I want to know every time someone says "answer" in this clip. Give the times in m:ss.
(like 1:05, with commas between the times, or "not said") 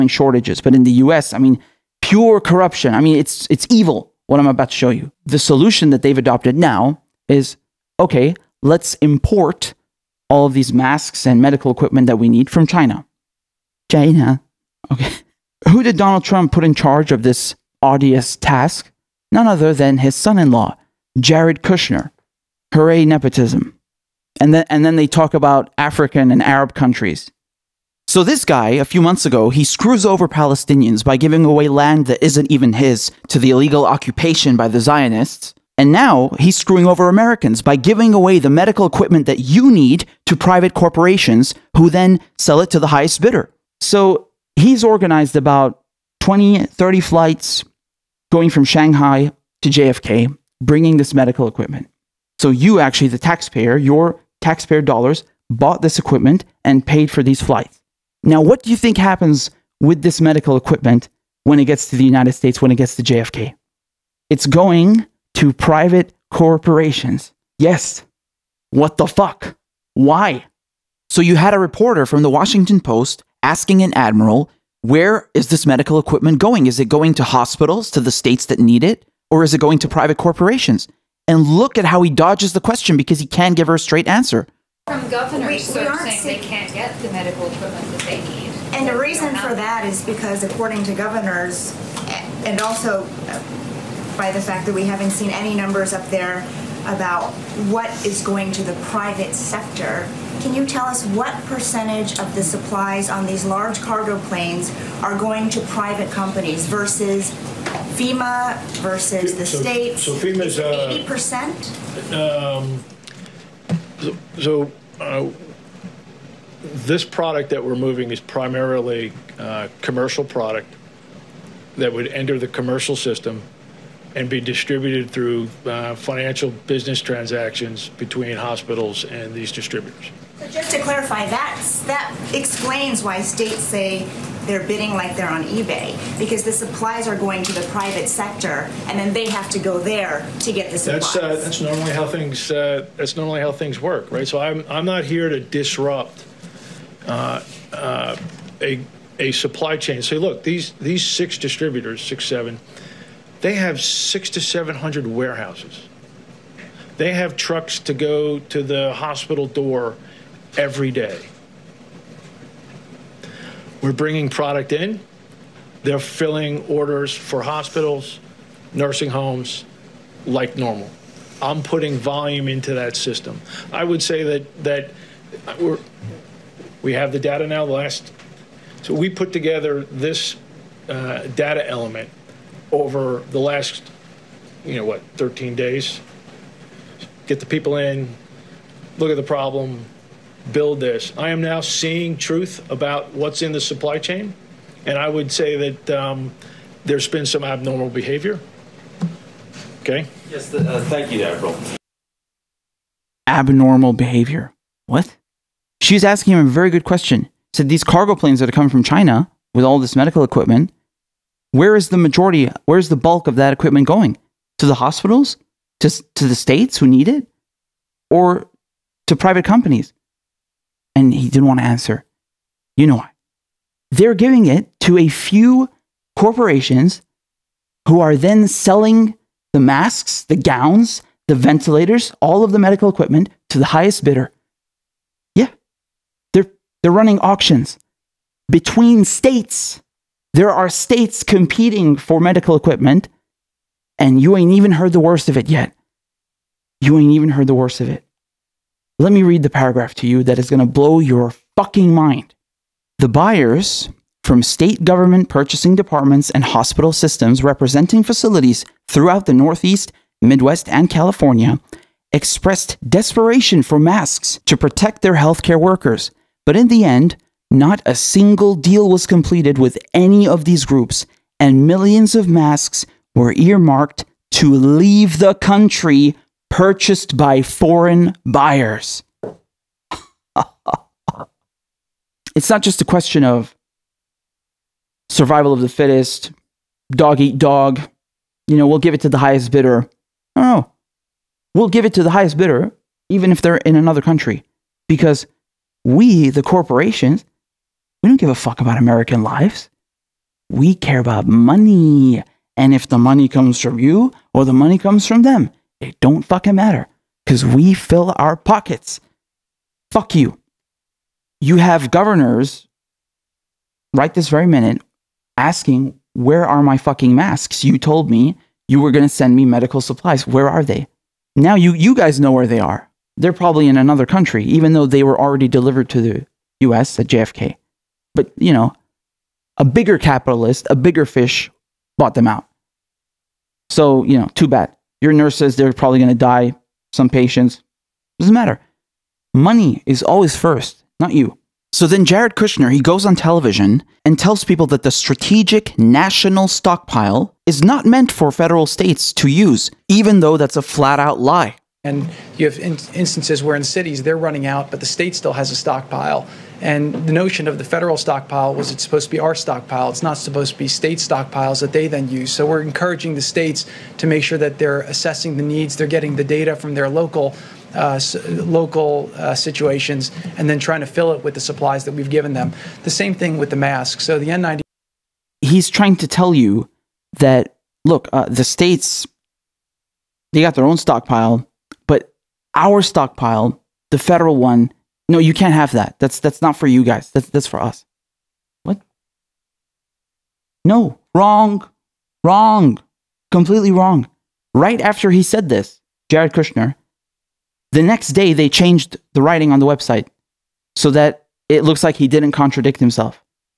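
1:24, 3:41.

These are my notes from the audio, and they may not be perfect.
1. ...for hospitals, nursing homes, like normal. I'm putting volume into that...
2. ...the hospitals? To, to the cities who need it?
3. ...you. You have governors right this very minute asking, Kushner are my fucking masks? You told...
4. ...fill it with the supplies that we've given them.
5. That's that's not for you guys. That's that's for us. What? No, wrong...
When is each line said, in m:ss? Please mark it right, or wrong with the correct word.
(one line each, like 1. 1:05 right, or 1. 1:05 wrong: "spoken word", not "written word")
1. 2:47 right
2. 3:34 wrong: "states", not "cities"
3. 5:10 wrong: "Where", not "Kushner"
4. 6:10 right
5. 6:25 right.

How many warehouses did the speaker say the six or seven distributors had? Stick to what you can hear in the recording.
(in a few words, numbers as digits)
600 to 700.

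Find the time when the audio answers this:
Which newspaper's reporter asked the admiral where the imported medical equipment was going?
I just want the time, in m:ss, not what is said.
1:12.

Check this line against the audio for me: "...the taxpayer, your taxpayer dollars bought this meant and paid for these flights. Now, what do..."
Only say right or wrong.
wrong.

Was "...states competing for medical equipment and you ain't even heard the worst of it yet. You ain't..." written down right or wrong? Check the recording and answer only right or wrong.
right.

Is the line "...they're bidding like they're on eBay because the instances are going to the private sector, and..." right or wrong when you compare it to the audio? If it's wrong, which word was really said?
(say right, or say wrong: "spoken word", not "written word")
wrong: "supplies", not "instances".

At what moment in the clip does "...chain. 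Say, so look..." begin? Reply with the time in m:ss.
2:29.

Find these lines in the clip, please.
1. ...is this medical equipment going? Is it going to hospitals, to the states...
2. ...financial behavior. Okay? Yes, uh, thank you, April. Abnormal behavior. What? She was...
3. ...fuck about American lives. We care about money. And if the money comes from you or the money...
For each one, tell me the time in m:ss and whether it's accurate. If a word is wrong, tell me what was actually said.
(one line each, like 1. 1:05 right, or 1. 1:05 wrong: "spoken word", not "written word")
1. 1:15 right
2. 3:17 wrong: "abnormal", not "financial"
3. 4:58 right.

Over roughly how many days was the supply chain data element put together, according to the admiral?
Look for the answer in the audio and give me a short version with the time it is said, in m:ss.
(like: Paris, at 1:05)
13 days, at 3:05.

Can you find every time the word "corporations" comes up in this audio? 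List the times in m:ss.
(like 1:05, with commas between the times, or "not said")
0:40, 1:06, 1:20, 3:46, 4:56.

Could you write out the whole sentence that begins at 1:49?
So FEMA's uh, eighty uh, percent.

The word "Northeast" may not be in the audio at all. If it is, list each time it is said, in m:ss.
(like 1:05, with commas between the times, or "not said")
4:19.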